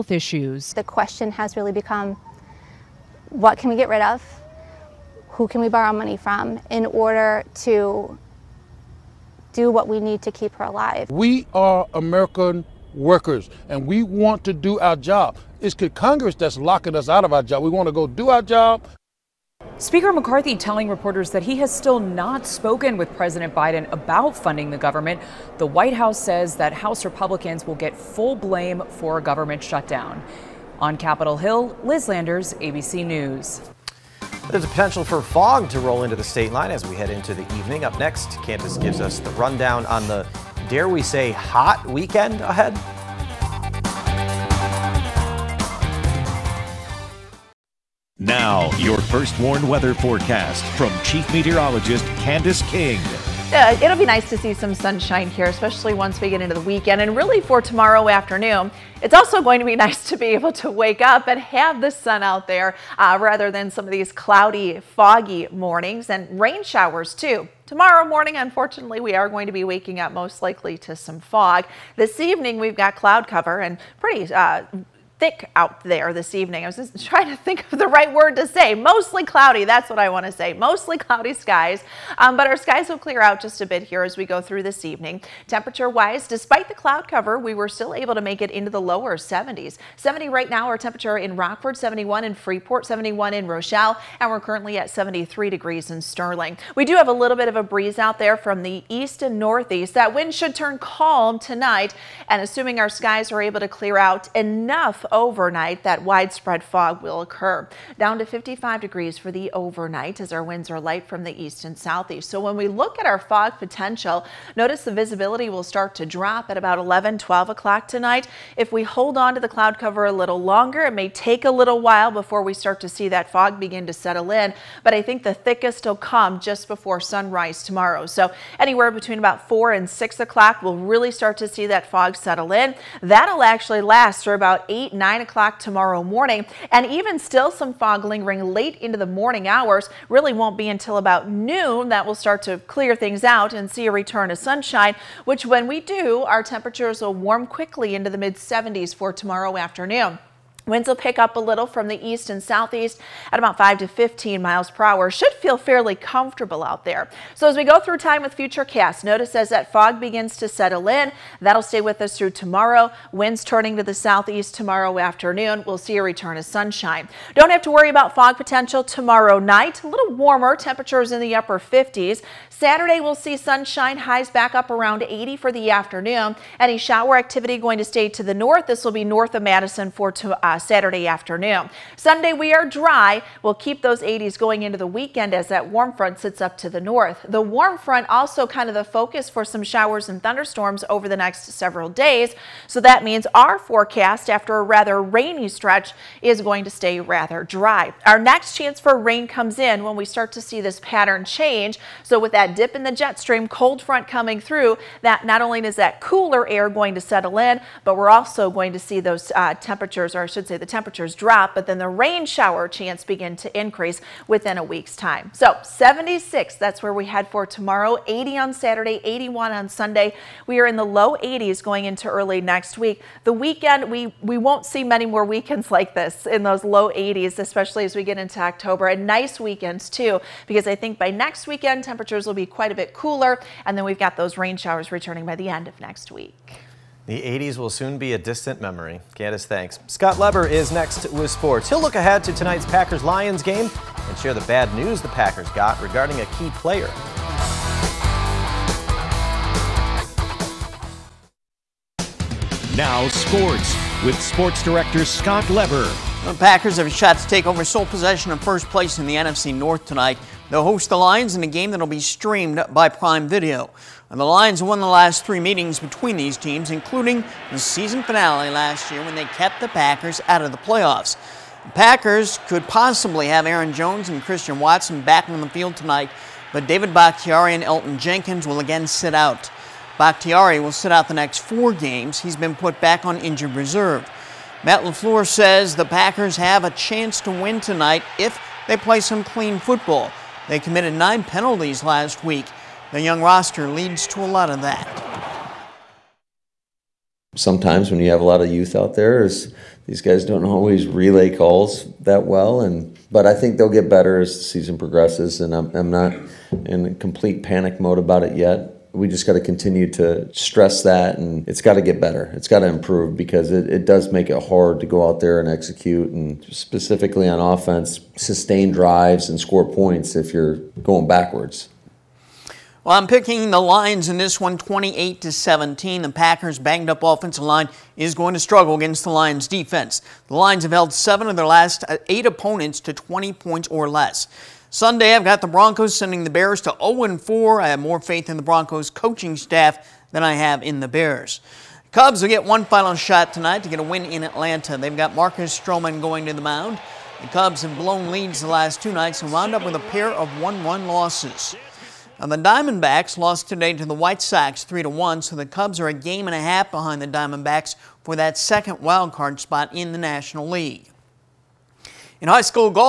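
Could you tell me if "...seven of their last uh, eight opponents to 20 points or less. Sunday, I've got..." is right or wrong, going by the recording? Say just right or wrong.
right.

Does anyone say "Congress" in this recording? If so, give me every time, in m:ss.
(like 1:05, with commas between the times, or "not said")
0:15.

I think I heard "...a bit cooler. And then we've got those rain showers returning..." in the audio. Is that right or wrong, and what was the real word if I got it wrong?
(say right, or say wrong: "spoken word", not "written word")
right.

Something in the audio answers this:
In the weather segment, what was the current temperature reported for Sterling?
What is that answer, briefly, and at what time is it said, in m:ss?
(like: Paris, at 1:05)
73 degrees, at 1:34.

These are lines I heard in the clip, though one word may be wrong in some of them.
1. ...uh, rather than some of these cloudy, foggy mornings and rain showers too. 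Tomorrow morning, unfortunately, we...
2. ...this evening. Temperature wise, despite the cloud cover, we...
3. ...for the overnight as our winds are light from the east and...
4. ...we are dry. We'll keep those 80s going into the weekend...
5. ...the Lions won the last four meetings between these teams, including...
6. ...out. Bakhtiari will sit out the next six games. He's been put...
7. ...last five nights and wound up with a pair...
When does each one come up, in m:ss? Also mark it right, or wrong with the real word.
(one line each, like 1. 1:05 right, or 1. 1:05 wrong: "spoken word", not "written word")
1. 1:02 right
2. 1:24 right
3. 1:49 right
4. 3:02 right
5. 4:24 wrong: "three", not "four"
6. 4:39 wrong: "four", not "six"
7. 5:48 wrong: "two", not "five".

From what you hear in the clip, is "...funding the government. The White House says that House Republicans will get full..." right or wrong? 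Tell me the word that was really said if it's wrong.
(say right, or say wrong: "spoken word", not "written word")
right.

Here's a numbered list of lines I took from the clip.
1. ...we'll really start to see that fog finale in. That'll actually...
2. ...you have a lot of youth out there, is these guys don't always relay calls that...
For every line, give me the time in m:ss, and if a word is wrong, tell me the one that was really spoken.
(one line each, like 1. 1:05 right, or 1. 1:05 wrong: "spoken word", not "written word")
1. 2:10 wrong: "settle", not "finale"
2. 4:57 right.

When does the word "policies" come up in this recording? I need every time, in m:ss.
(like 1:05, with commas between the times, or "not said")
not said.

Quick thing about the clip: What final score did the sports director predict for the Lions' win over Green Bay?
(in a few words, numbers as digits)
28 to 17.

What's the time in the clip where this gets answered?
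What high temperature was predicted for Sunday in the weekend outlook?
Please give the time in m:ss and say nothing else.
3:39.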